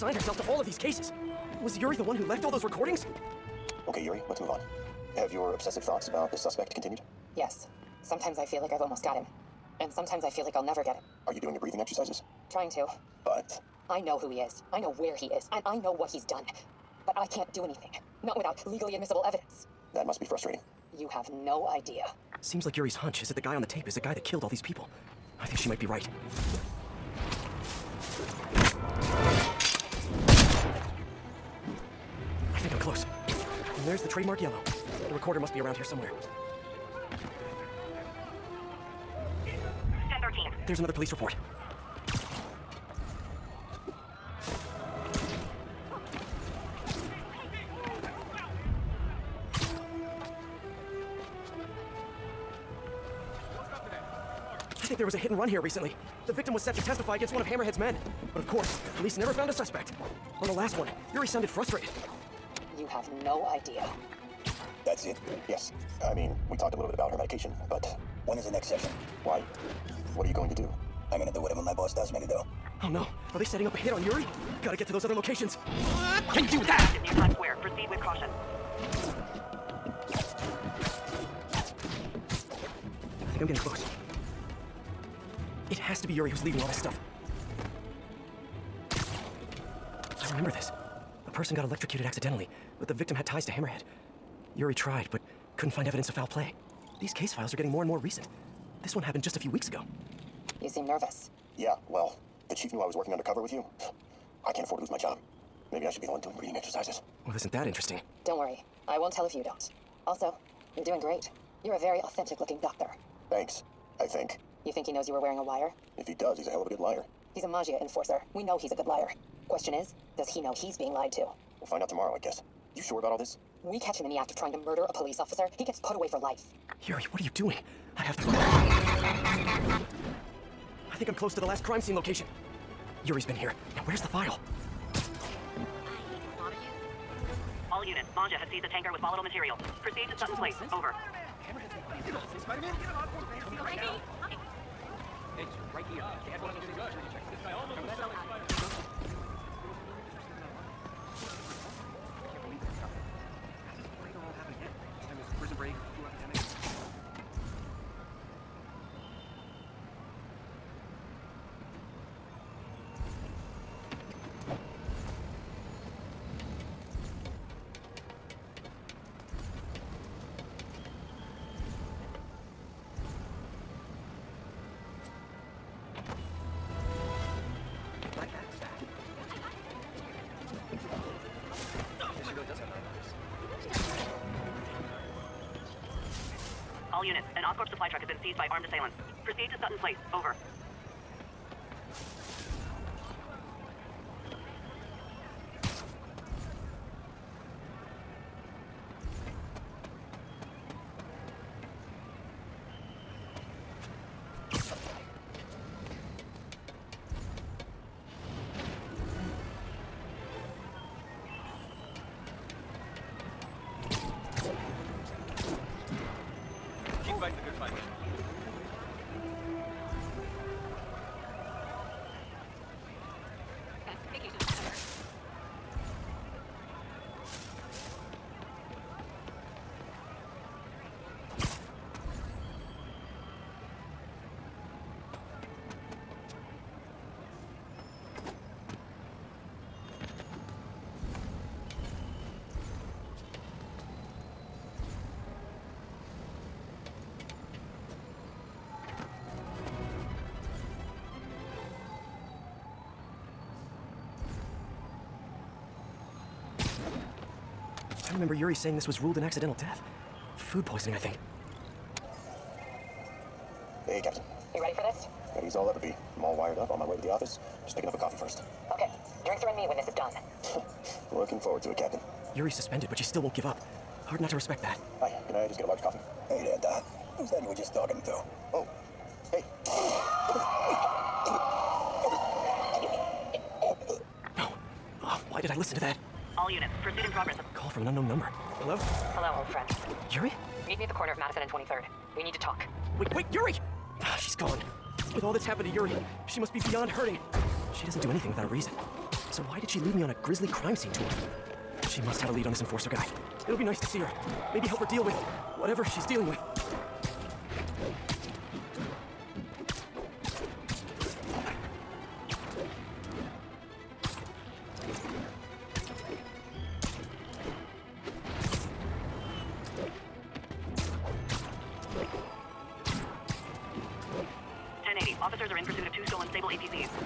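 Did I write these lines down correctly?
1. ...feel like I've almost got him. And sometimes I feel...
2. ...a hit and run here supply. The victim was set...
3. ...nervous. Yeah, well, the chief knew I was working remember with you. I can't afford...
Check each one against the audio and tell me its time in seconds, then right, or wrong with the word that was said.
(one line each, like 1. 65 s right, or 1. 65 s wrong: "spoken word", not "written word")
1. 8 s right
2. 55 s wrong: "recently", not "supply"
3. 100 s wrong: "undercover", not "remember".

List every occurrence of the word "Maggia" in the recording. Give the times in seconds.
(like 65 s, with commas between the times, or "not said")
117 s, 138 s.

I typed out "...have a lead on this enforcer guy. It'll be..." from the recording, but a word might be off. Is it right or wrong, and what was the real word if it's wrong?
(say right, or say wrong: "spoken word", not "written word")
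right.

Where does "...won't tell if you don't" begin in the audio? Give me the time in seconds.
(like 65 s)
108 s.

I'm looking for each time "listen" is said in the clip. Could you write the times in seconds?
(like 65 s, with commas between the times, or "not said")
285 s.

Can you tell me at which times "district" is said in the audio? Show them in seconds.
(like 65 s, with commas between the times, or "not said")
not said.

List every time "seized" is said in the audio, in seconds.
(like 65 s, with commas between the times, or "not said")
138 s, 188 s.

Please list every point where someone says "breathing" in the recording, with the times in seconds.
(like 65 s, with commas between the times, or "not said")
11 s, 106 s.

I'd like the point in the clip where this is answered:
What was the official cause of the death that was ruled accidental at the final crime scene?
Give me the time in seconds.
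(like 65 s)
260 s.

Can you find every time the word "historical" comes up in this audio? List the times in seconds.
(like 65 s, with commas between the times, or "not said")
not said.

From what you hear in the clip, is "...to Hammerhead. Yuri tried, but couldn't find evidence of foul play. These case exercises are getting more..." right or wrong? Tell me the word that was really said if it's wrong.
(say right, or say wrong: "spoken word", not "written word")
wrong: "files", not "exercises".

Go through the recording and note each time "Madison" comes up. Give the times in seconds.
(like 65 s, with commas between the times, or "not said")
291 s.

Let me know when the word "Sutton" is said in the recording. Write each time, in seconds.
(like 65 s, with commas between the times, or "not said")
140 s, 189 s.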